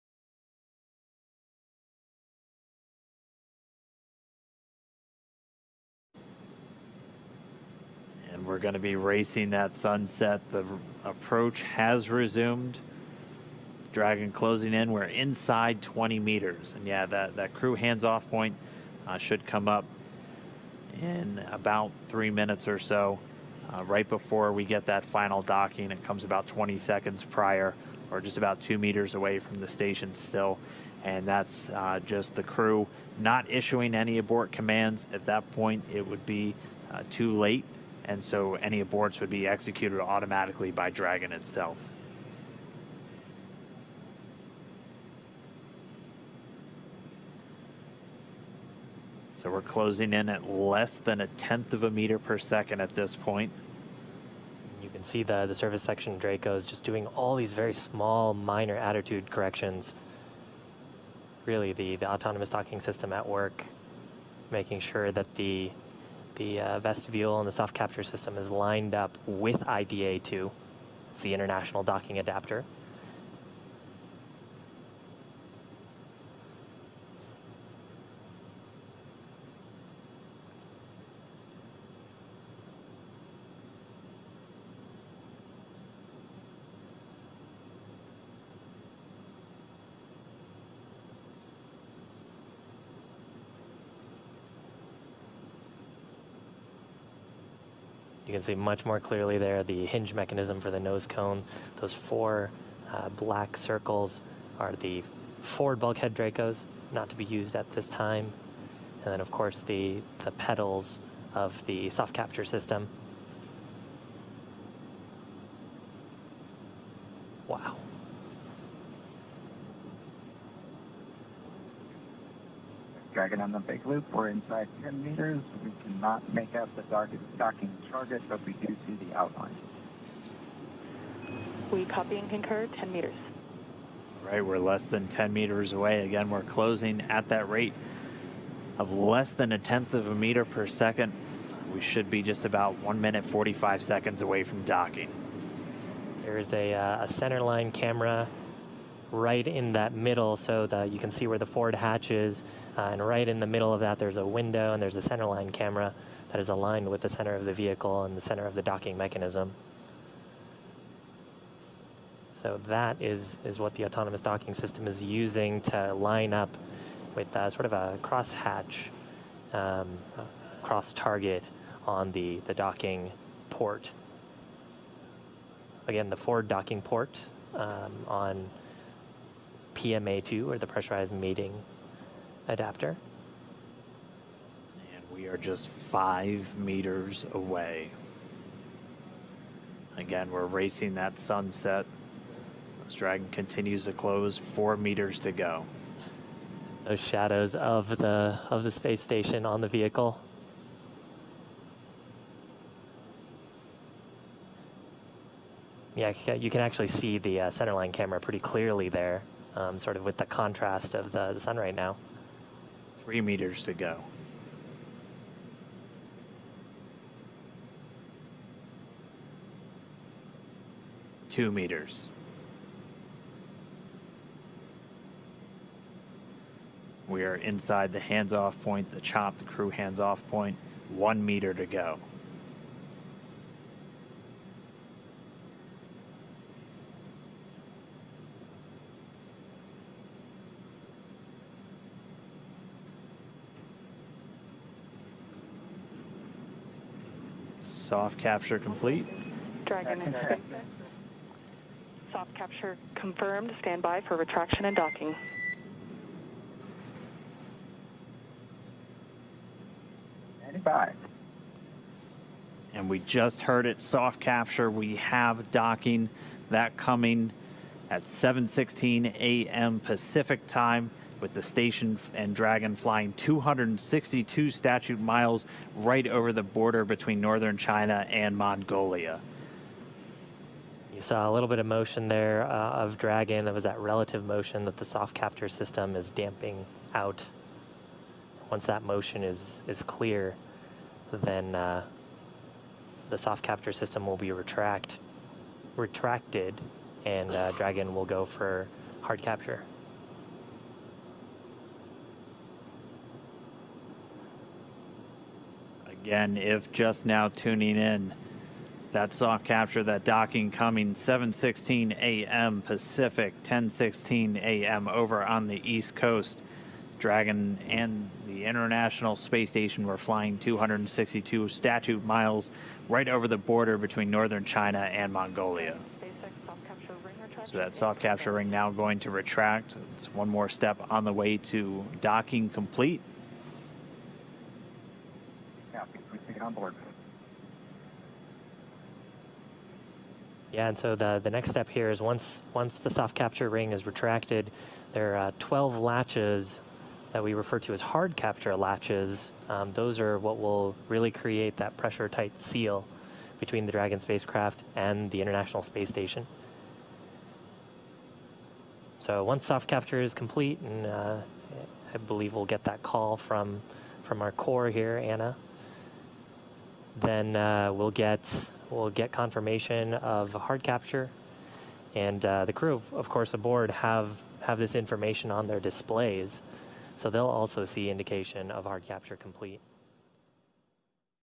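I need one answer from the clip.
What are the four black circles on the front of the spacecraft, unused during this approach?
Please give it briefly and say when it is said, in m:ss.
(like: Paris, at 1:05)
forward bulkhead Dracos, at 1:45.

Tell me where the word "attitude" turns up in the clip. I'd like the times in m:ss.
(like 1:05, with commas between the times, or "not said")
0:58.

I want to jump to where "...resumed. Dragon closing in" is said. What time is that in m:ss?
0:12.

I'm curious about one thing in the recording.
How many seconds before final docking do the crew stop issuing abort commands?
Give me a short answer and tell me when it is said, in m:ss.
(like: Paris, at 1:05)
20 seconds, at 0:26.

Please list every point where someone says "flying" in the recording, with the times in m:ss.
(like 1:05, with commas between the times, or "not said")
4:32, 5:19.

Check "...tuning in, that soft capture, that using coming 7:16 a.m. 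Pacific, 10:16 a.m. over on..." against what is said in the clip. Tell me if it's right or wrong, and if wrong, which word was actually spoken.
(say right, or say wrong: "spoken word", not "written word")
wrong: "docking", not "using".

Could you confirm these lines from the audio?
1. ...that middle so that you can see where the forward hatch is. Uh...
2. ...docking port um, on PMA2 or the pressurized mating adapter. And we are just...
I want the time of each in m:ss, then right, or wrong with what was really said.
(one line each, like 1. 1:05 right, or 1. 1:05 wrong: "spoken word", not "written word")
1. 2:29 right
2. 2:56 right.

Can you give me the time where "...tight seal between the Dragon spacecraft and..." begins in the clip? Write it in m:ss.
5:52.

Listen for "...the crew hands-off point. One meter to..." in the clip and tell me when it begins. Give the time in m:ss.
3:49.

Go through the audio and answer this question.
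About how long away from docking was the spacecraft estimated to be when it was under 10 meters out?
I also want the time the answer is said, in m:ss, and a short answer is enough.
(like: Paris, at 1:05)
1 minute 45 seconds, at 2:22.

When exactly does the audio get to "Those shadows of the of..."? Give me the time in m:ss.
3:16.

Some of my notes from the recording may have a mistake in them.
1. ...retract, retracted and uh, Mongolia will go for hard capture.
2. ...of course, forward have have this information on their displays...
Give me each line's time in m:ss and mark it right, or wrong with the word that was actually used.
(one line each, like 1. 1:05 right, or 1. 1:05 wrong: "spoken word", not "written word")
1. 4:54 wrong: "Dragon", not "Mongolia"
2. 6:12 wrong: "aboard", not "forward".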